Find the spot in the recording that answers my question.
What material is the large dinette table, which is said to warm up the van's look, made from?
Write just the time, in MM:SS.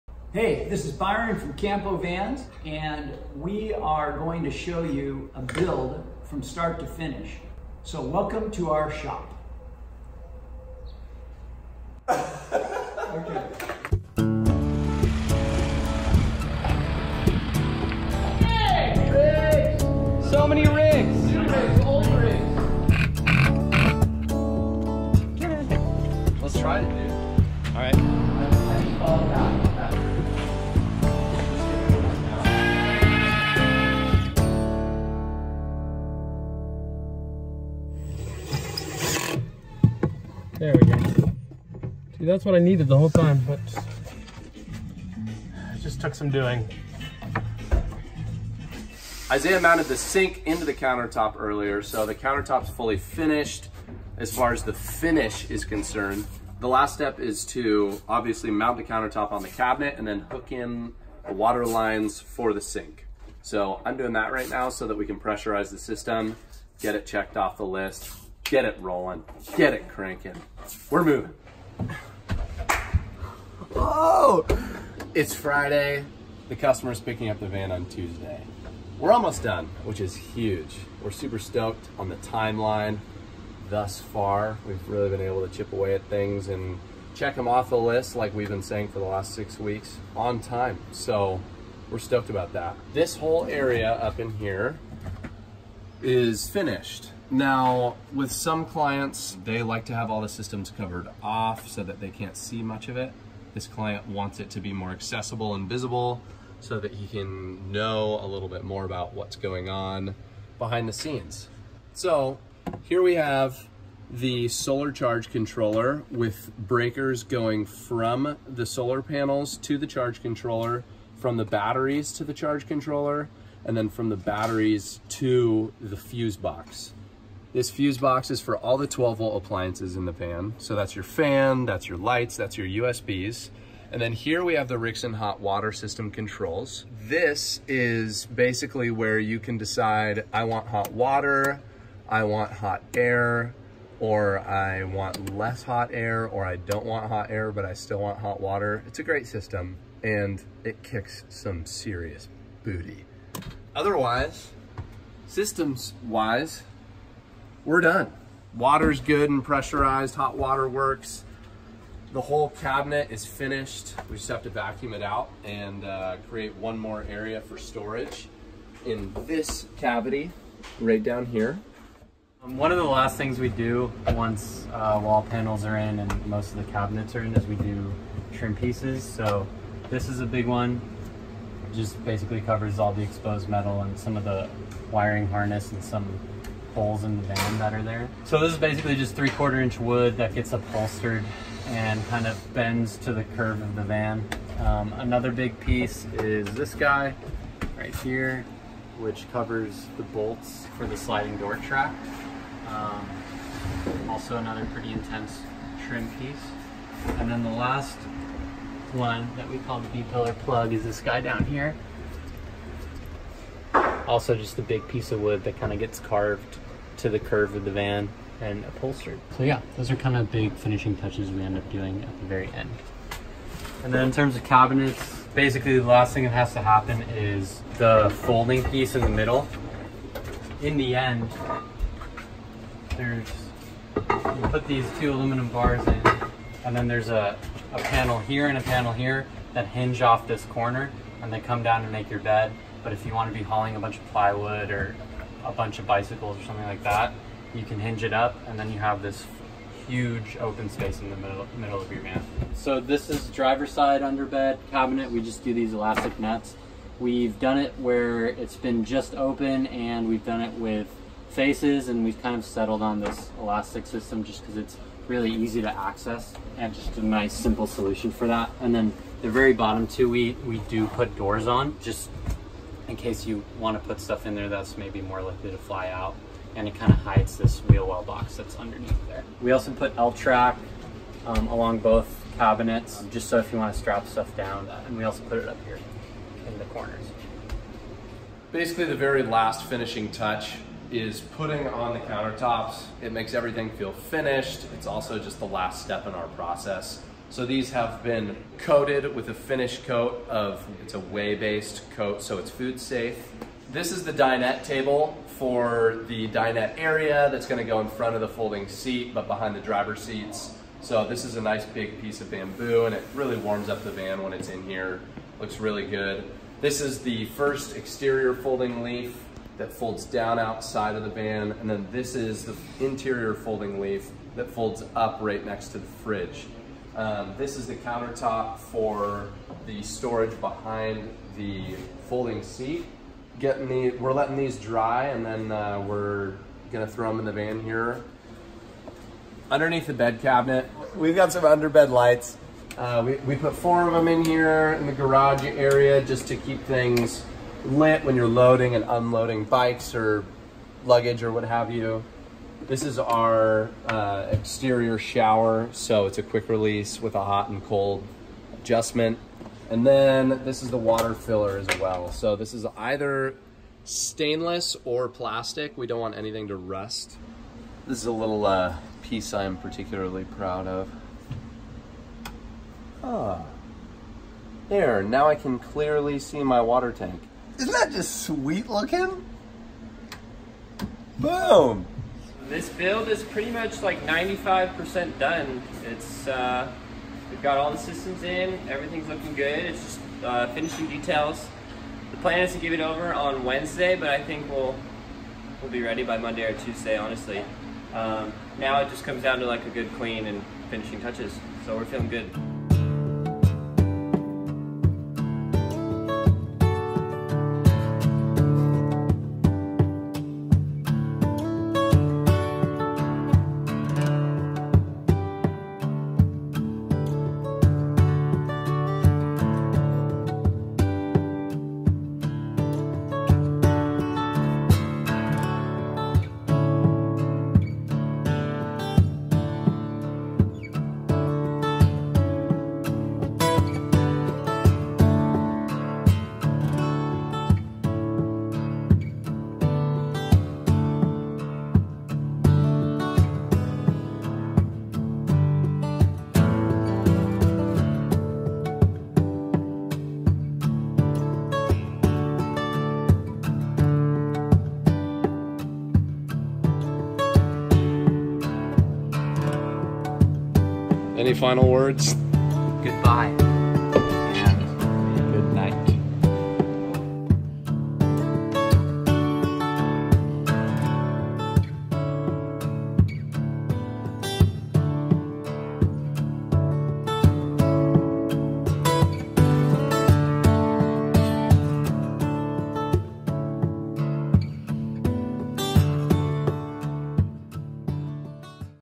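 05:12.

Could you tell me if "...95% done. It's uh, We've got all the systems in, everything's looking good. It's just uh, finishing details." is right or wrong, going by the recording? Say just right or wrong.
right.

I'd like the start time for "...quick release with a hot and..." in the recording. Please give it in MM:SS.
05:56.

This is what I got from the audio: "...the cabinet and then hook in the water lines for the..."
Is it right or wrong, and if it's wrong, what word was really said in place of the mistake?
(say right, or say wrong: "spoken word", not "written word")
right.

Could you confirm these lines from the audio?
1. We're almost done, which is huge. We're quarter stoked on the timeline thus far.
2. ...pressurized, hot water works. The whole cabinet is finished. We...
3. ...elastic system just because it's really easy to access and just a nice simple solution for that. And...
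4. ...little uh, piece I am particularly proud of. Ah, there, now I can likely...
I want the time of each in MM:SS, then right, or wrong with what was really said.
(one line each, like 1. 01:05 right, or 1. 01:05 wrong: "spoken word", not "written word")
1. 01:18 wrong: "super", not "quarter"
2. 02:39 right
3. 04:23 right
4. 06:08 wrong: "clearly", not "likely".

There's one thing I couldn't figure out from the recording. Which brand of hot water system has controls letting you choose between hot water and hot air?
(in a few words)
Rixen.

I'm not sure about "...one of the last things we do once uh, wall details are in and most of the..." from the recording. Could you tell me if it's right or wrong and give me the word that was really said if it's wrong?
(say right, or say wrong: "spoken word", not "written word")
wrong: "panels", not "details".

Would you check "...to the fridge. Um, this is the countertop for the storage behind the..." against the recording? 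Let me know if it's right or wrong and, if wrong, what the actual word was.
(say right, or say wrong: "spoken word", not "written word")
right.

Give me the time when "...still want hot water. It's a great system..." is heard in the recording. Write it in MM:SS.
02:27.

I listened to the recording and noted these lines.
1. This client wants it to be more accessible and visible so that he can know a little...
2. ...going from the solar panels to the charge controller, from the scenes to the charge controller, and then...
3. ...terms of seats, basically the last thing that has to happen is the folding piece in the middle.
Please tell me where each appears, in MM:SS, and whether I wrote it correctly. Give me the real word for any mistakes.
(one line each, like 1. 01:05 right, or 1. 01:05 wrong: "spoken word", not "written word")
1. 01:43 right
2. 01:57 wrong: "batteries", not "scenes"
3. 03:44 wrong: "cabinets", not "seats".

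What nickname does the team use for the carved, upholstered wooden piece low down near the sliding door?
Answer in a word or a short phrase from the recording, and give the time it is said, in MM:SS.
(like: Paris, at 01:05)
B-pillar plug, at 03:29.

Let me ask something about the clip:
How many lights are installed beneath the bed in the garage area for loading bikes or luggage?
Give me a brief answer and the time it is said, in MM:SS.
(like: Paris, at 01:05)
4, at 05:43.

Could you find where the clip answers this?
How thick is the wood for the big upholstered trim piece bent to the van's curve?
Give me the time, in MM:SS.
03:09.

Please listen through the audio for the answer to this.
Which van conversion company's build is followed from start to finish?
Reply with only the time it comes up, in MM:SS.
00:01.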